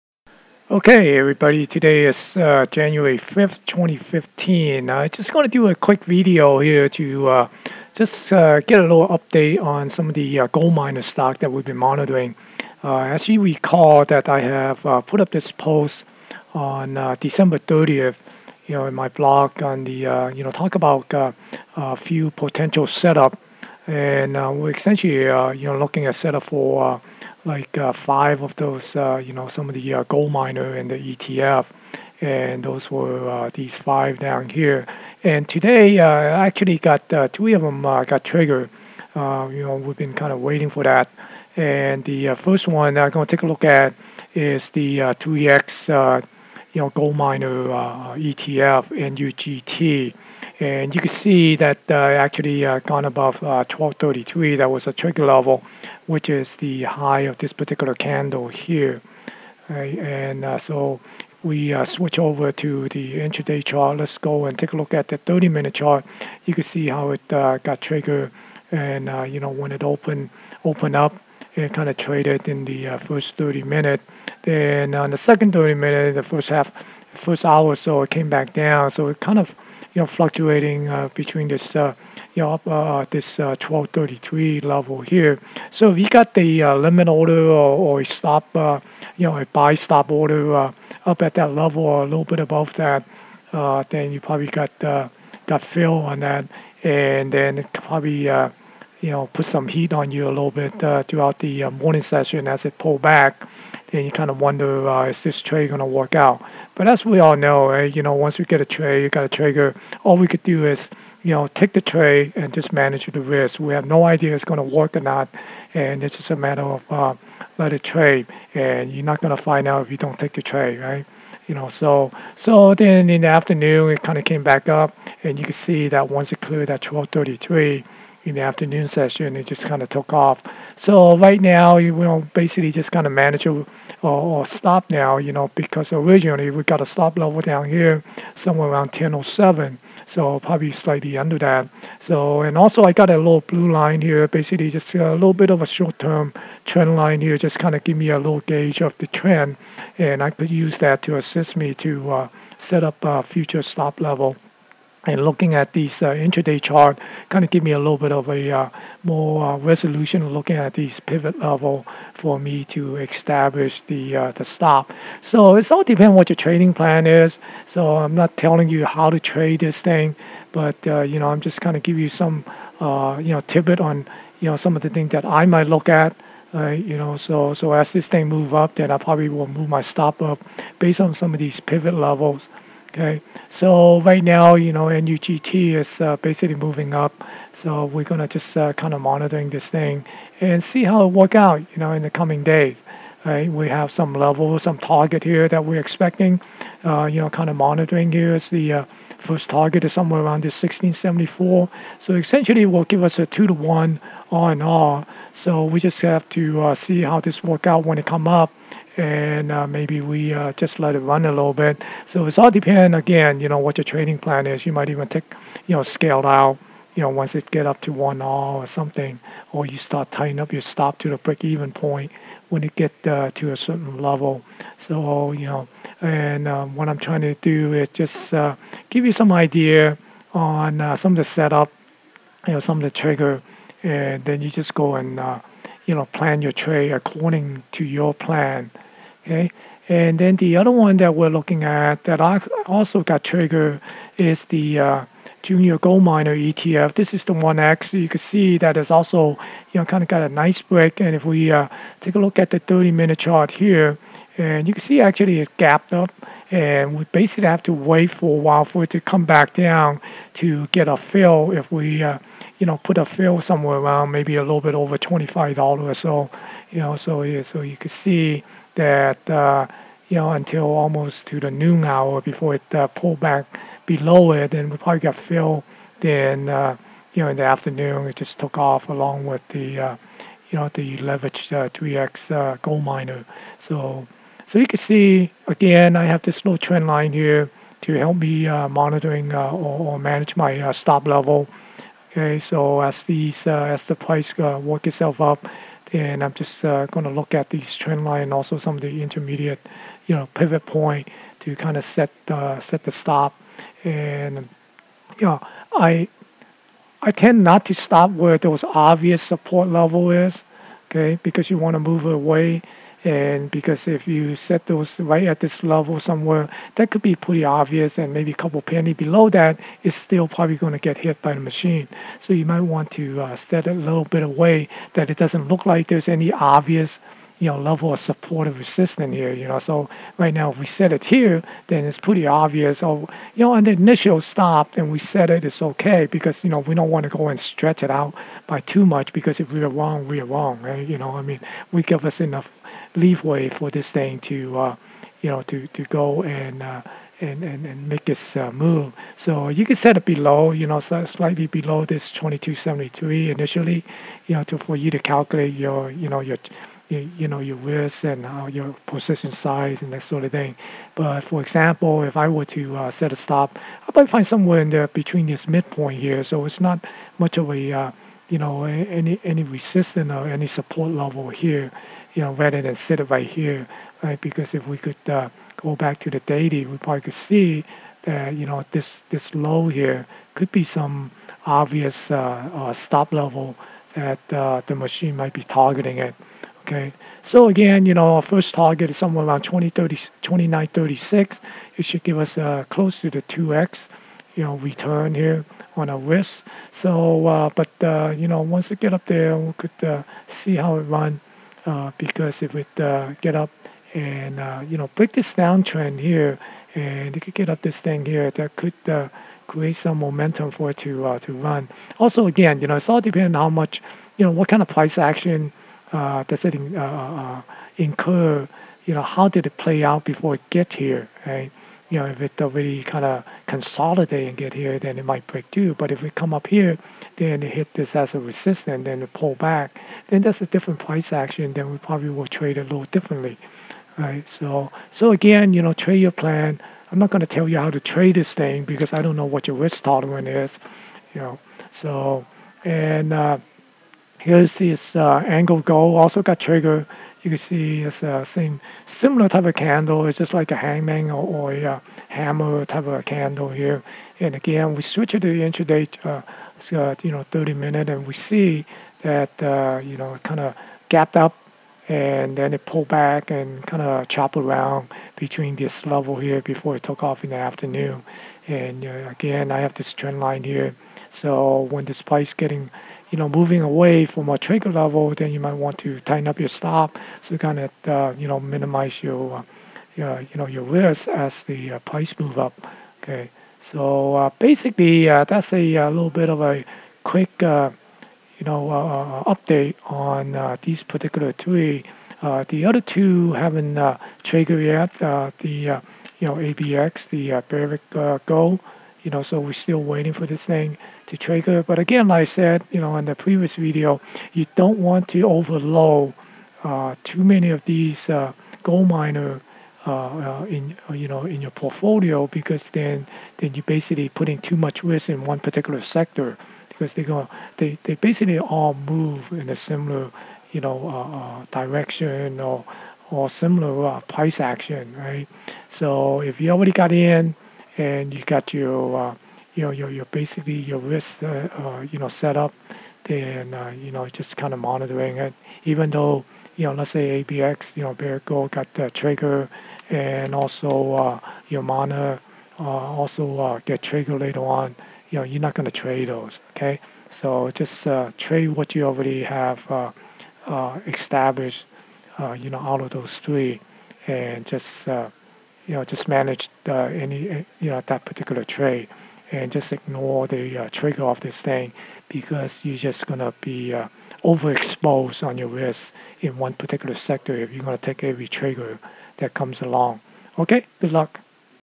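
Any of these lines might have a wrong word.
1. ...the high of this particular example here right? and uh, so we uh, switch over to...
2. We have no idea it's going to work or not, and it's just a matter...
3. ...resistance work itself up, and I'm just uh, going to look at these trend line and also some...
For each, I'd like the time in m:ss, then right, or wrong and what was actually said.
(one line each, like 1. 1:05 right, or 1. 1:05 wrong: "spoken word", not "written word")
1. 0:56 wrong: "candle", not "example"
2. 1:53 right
3. 4:53 wrong: "price", not "resistance".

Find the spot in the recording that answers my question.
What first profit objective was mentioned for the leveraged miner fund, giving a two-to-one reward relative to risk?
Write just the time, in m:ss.
3:20.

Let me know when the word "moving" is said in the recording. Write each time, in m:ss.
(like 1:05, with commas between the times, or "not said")
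3:06, 7:53.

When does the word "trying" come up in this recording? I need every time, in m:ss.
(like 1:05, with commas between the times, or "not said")
3:46.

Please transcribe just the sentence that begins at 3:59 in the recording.
Okay, and then the other one that we're looking at that I also got trigger is the uh, junior gold miner ETF.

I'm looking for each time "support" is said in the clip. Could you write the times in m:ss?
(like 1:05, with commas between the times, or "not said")
5:09, 5:27, 6:10.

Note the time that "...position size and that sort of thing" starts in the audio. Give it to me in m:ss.
5:58.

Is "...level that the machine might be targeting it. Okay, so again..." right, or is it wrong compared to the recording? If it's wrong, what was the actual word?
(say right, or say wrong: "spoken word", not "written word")
right.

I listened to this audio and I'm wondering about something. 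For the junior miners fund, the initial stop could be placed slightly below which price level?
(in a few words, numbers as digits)
22.73.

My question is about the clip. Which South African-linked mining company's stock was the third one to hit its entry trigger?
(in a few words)
AngloGold.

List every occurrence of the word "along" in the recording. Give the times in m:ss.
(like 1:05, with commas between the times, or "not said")
4:38, 9:29.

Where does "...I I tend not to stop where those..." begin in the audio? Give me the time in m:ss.
5:05.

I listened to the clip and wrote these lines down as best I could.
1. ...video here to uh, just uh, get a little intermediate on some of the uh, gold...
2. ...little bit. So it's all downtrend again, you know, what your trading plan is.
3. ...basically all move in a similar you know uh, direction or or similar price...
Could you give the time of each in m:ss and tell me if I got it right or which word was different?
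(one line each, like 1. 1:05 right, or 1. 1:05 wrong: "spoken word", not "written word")
1. 0:06 wrong: "update", not "intermediate"
2. 3:31 wrong: "depend", not "downtrend"
3. 8:37 right.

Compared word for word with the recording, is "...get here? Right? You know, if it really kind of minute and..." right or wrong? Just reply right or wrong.
wrong.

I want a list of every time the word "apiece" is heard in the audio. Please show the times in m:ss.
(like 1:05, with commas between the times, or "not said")
not said.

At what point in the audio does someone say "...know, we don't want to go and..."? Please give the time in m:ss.
5:36.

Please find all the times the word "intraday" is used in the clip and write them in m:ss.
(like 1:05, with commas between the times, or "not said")
1:03, 2:36, 7:35.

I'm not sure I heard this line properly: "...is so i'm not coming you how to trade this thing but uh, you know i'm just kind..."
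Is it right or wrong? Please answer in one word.
wrong.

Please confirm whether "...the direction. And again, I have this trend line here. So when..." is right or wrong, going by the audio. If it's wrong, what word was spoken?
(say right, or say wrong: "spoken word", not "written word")
wrong: "afternoon", not "direction".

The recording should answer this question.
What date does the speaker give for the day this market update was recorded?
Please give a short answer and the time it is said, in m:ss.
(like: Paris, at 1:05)
January 5th, 2015, at 0:02.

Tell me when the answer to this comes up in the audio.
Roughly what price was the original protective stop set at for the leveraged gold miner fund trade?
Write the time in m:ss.
2:18.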